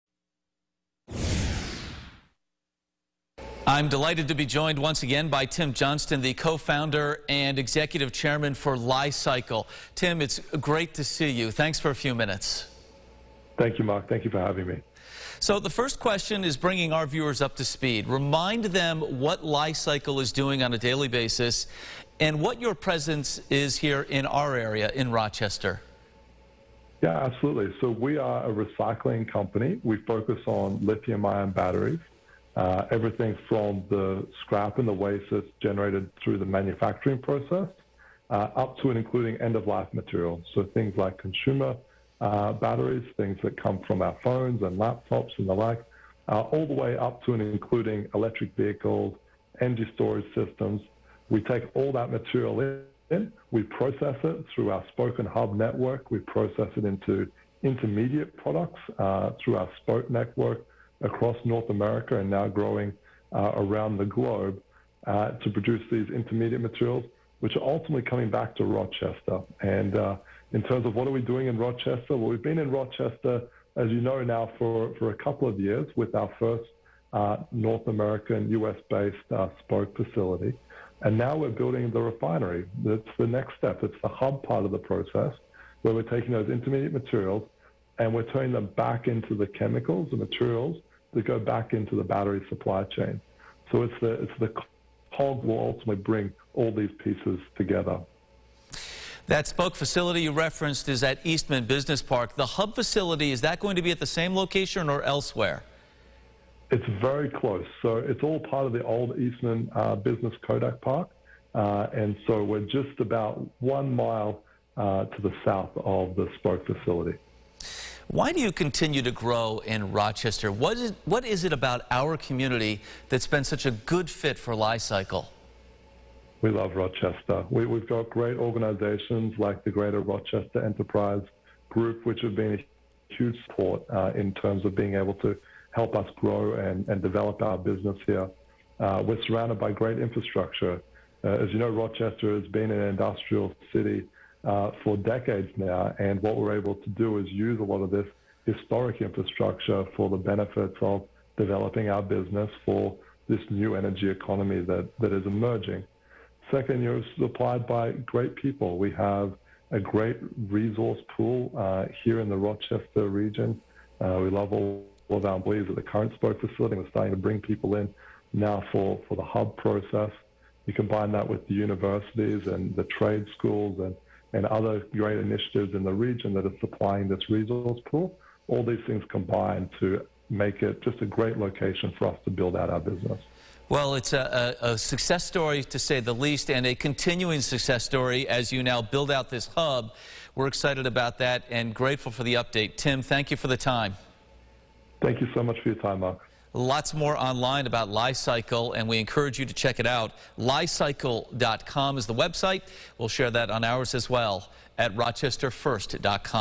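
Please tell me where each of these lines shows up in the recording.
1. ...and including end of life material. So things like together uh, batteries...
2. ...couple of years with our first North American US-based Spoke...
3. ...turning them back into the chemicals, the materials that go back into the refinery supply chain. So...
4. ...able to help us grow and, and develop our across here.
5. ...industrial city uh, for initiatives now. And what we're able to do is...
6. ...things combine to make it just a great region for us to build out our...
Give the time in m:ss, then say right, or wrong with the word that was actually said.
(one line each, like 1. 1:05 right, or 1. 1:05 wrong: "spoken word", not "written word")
1. 0:38 wrong: "consumer", not "together"
2. 1:15 right
3. 1:28 wrong: "battery", not "refinery"
4. 2:14 wrong: "business", not "across"
5. 2:22 wrong: "decades", not "initiatives"
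6. 2:58 wrong: "location", not "region".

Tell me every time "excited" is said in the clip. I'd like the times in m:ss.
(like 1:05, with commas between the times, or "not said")
3:10.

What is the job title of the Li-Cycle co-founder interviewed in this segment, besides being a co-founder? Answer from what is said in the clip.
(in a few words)
Executive chairman.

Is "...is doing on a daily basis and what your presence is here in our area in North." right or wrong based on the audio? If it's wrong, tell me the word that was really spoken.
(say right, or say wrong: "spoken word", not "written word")
wrong: "Rochester", not "North".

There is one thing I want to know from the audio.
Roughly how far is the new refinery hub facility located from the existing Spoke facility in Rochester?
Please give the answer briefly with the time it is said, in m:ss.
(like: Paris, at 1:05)
1 mile, at 1:53.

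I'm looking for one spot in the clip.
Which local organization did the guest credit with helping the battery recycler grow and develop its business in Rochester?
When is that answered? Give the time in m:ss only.
2:09.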